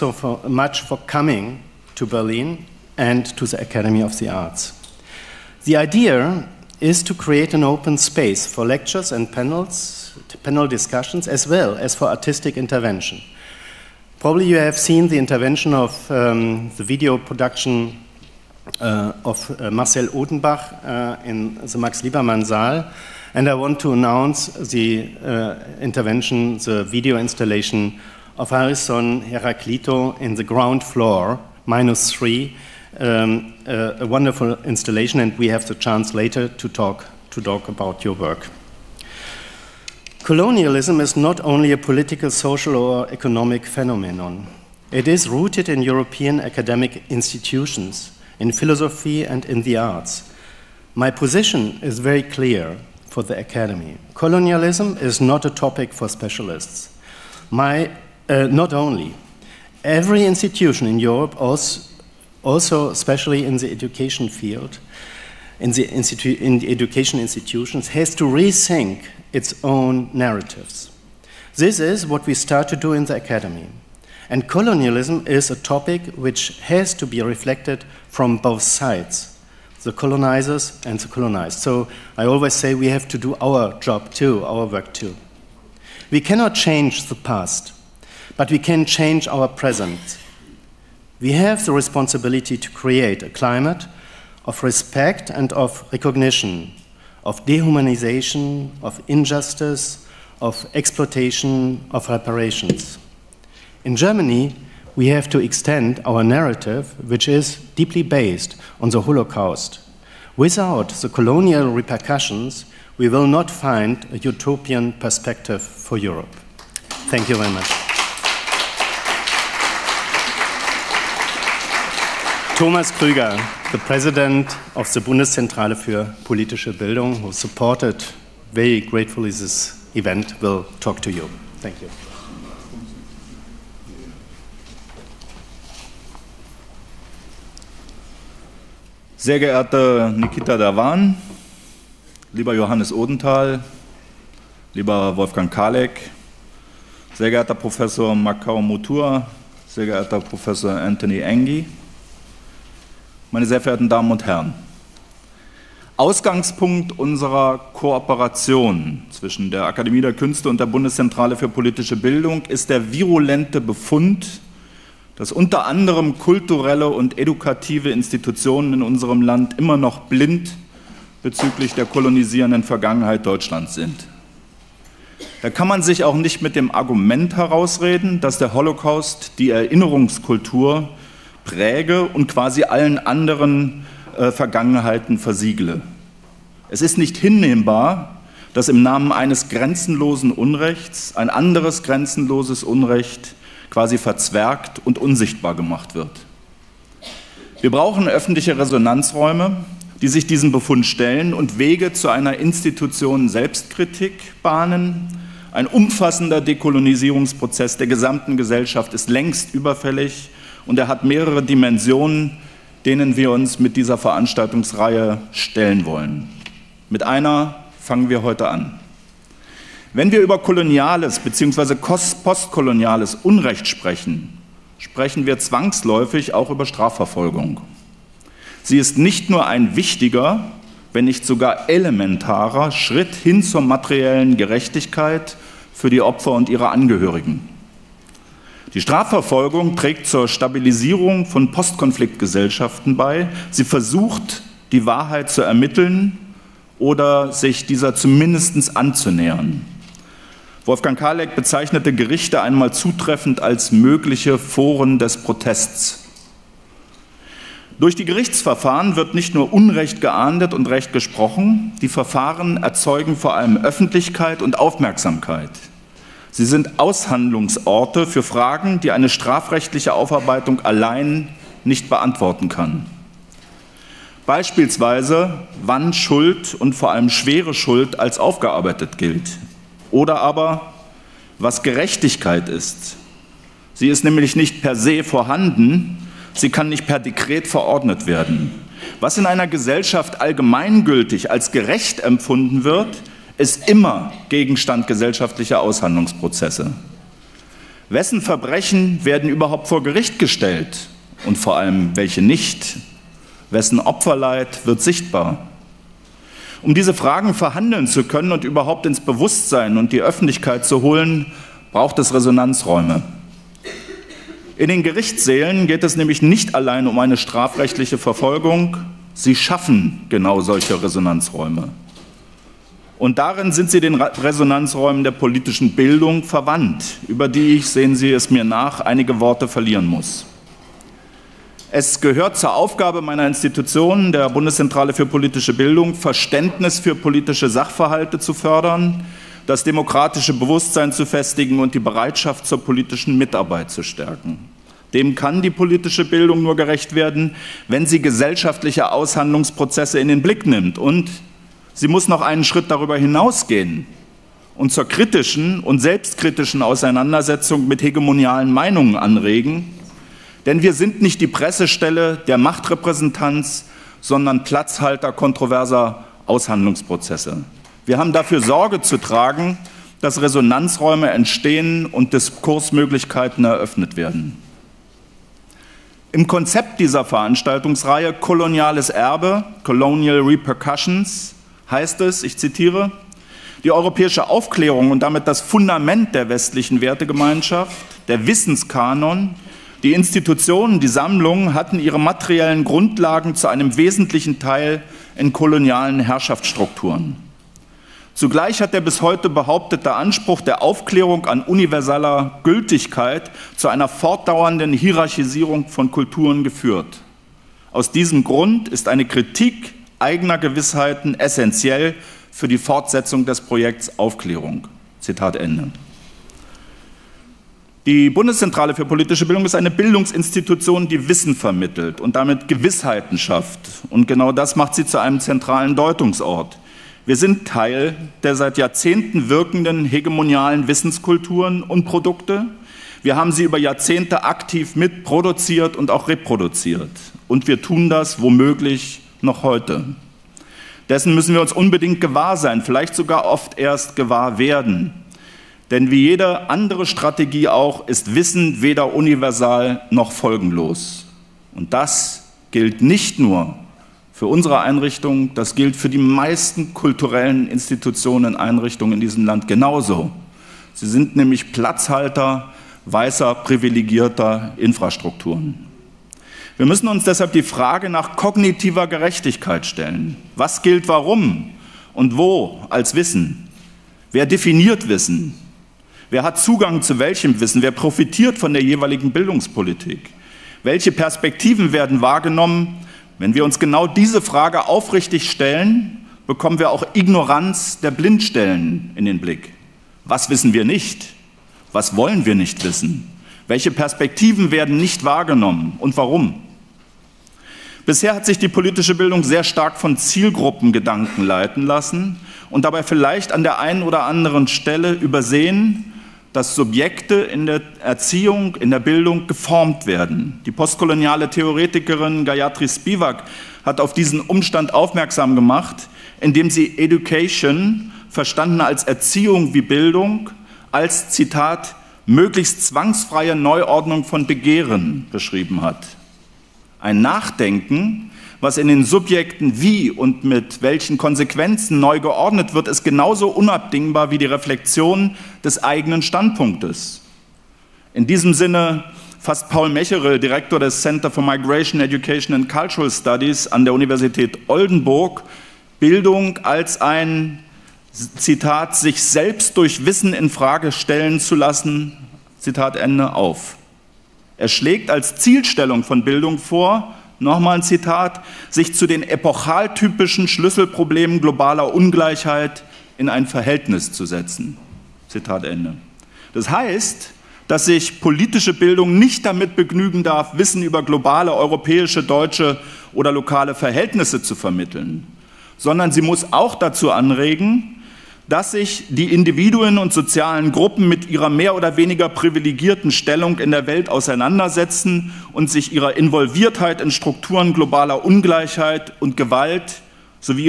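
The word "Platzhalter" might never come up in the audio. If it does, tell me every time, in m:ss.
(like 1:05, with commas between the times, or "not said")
6:04, 7:41.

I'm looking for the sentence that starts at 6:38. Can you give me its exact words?
Zugleich hat der bis heute behauptete Anspruch der Aufklärung an universaler Gültigkeit zu einer fortdauernden Hierarchisierung von Kulturen geführt.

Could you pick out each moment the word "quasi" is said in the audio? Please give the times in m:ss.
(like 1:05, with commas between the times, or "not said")
3:02, 3:13.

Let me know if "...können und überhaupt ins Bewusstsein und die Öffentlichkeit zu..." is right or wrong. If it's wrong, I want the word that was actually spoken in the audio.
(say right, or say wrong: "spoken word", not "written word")
right.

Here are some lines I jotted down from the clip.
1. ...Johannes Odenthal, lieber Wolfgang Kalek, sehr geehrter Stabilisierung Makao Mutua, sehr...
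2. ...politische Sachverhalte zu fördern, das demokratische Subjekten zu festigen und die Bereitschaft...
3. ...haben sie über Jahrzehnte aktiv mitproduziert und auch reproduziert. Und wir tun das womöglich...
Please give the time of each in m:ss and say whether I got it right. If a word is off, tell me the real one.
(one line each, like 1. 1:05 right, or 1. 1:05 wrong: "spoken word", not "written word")
1. 2:22 wrong: "Professor", not "Stabilisierung"
2. 5:36 wrong: "Bewusstsein", not "Subjekten"
3. 7:13 right.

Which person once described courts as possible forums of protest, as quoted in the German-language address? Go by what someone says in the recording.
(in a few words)
Wolfgang Kaleck.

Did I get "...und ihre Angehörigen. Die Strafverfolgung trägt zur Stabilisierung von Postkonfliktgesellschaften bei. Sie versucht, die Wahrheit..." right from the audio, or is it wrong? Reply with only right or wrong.
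right.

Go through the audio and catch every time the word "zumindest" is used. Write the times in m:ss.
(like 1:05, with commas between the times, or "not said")
4:07.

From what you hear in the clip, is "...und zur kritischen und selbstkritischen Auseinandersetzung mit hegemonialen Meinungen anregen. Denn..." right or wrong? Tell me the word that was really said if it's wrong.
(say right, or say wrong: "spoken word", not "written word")
right.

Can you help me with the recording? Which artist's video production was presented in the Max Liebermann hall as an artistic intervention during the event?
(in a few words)
Marcel Odenbach.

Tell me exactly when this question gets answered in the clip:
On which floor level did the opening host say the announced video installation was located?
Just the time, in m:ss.
0:31.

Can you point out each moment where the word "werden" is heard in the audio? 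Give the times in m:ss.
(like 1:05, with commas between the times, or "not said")
4:48, 4:59, 5:46, 6:13, 7:24, 8:01, 8:14, 8:29.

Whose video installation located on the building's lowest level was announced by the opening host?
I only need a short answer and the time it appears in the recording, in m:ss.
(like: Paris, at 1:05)
Ayrson Heráclito, at 0:28.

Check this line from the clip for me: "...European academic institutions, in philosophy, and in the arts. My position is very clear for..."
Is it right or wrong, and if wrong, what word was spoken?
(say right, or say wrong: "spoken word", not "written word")
right.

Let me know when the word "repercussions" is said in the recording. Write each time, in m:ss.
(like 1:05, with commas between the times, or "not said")
1:51, 6:20.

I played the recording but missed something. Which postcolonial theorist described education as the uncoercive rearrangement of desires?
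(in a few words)
Gayatri Spivak.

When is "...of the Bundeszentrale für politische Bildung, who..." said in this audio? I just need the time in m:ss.
2:04.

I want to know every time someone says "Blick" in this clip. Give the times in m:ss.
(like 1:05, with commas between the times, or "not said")
5:50, 8:09.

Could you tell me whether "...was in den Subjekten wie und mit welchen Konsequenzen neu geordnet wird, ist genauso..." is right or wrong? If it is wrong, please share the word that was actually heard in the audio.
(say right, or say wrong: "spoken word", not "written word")
right.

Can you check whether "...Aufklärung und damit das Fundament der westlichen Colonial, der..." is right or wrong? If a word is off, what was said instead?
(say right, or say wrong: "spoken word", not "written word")
wrong: "Wertegemeinschaft", not "Colonial".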